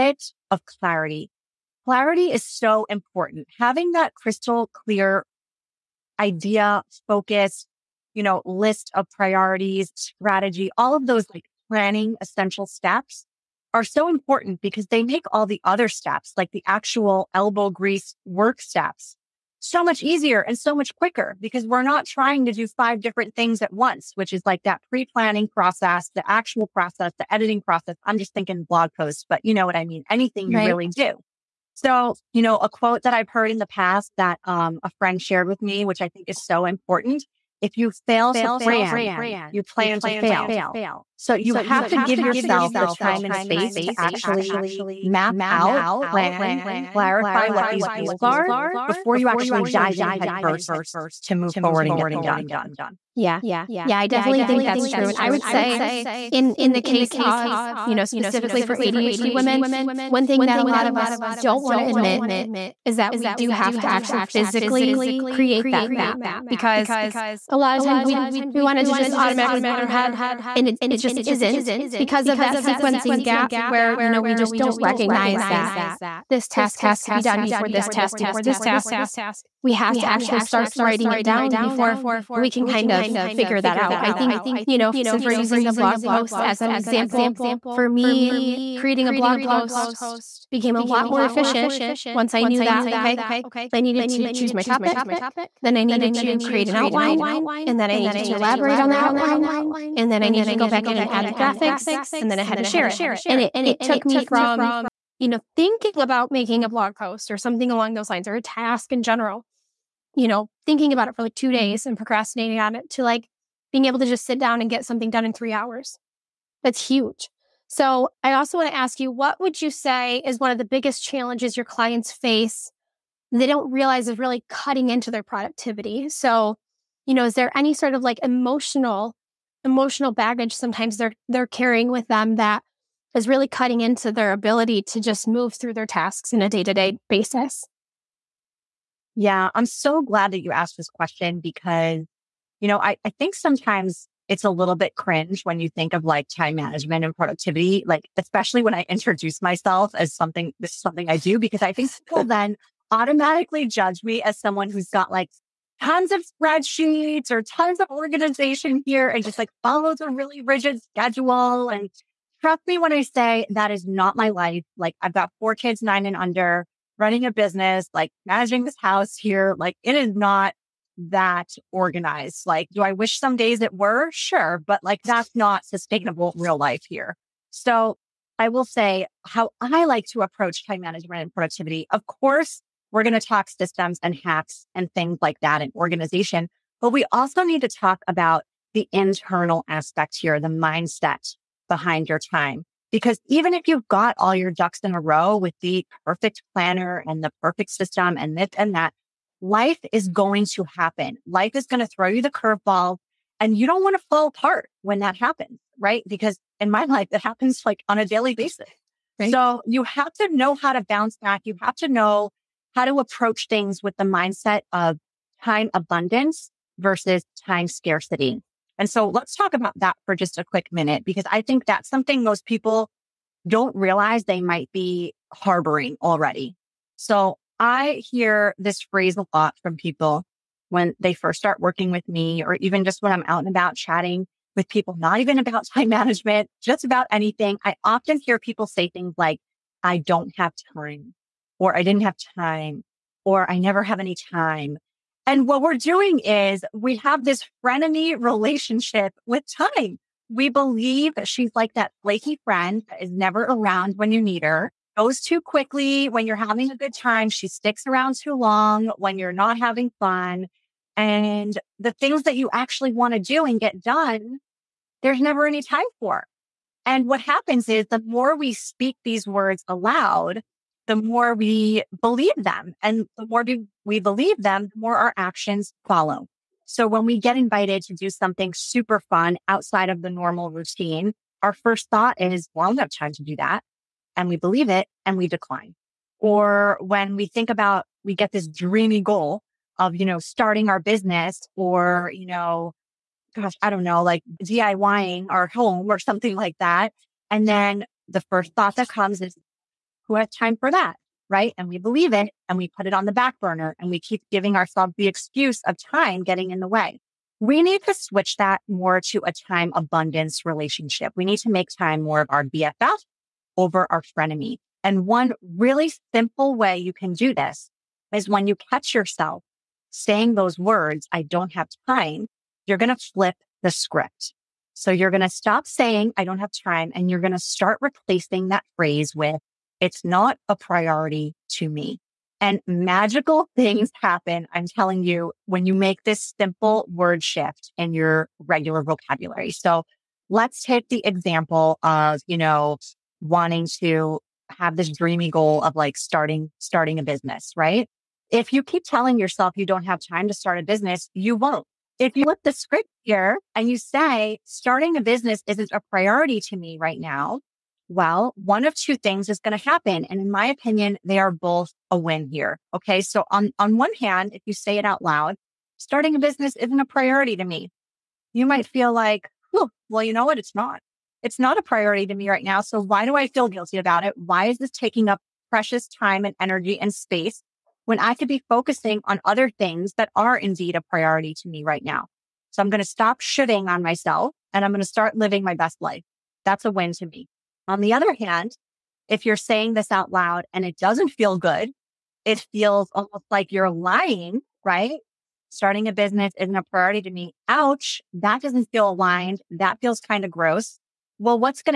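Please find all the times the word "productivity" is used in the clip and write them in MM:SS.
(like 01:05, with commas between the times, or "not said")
02:05, 02:27, 03:01.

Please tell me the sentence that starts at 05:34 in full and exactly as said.
I'm telling you, when you make this simple word shift in your regular vocabulary.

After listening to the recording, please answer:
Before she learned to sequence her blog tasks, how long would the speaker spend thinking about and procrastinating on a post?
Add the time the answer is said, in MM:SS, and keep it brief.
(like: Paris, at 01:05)
2 days, at 01:51.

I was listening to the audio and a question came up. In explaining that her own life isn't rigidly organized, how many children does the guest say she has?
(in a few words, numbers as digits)
4.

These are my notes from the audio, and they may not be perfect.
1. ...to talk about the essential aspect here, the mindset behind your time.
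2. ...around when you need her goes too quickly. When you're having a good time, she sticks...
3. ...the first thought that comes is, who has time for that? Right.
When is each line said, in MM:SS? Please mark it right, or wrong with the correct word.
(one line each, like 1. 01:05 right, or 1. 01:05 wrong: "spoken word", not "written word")
1. 03:07 wrong: "internal", not "essential"
2. 04:13 right
3. 04:58 right.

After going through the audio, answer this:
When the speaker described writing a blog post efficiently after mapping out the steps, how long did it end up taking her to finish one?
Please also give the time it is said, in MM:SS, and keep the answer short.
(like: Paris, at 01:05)
3 hours, at 01:55.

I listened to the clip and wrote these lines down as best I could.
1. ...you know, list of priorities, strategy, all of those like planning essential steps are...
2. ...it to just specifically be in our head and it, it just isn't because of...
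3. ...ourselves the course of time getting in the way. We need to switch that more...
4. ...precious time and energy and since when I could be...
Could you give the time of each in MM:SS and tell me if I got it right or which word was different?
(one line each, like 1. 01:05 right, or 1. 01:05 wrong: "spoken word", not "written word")
1. 00:08 right
2. 01:08 wrong: "automatically", not "specifically"
3. 05:04 wrong: "excuse", not "course"
4. 06:15 wrong: "space", not "since".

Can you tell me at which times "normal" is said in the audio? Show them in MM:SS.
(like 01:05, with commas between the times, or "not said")
04:40.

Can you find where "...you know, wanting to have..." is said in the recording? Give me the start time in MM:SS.
05:42.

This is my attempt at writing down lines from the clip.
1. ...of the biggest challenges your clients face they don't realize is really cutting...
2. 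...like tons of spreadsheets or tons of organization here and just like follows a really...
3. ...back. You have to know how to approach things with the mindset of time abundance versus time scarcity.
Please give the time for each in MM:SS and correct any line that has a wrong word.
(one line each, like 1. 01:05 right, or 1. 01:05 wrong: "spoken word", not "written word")
1. 02:00 right
2. 02:35 right
3. 03:31 right.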